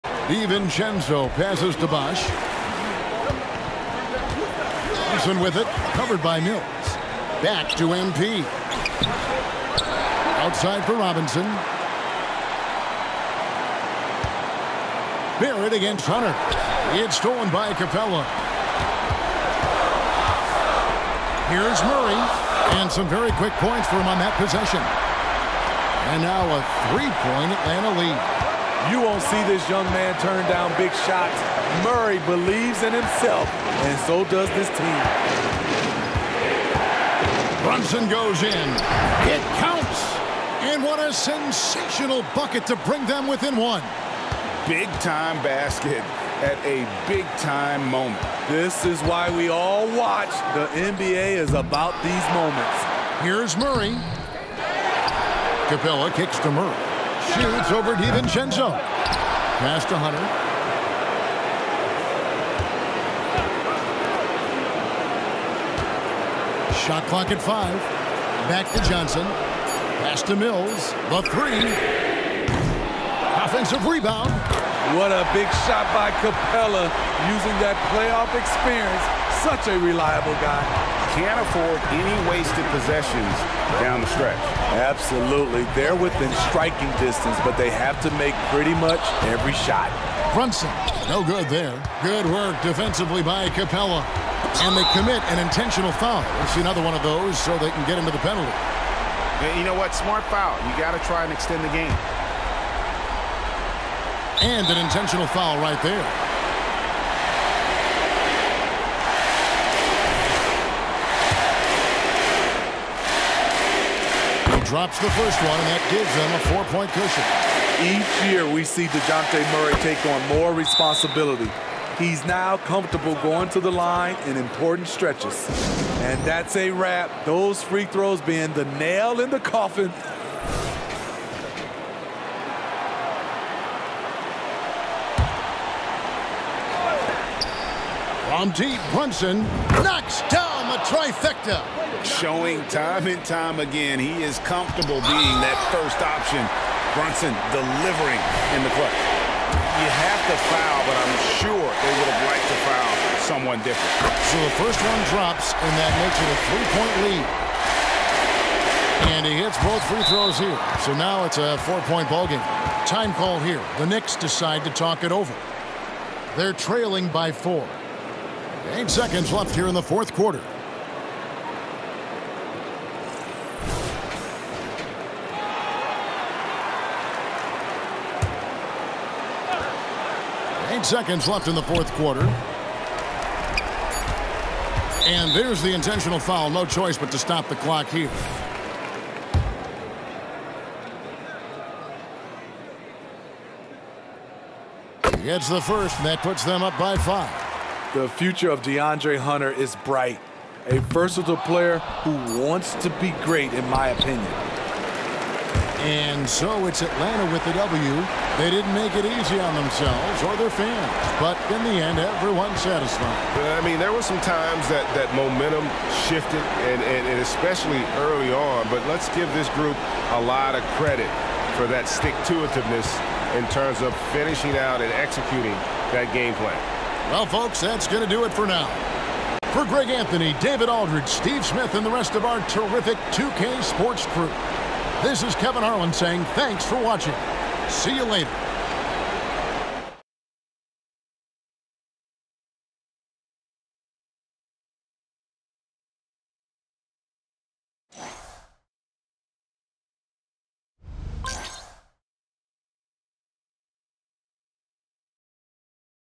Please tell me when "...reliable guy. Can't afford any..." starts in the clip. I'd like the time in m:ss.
1:19.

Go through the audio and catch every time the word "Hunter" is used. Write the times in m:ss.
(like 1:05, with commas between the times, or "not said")
0:16, 0:59, 3:19.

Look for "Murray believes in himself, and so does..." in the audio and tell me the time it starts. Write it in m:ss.
0:31.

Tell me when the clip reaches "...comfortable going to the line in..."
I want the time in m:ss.
2:02.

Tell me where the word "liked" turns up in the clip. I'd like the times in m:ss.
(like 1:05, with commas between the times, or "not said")
2:32.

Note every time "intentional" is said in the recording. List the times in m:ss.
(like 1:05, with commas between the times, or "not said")
1:35, 1:44, 3:05.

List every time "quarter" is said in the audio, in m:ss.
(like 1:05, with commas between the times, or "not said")
2:50, 3:01.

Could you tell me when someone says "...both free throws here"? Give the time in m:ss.
2:39.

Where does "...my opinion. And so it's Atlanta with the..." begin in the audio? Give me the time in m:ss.
3:23.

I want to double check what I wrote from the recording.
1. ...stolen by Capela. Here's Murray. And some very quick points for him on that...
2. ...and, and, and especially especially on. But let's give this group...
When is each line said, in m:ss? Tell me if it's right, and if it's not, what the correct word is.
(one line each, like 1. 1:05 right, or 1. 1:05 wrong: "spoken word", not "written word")
1. 0:17 right
2. 3:36 wrong: "early", not "especially".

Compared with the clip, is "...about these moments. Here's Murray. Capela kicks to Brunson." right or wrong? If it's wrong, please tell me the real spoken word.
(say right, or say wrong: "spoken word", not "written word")
wrong: "Murray", not "Brunson".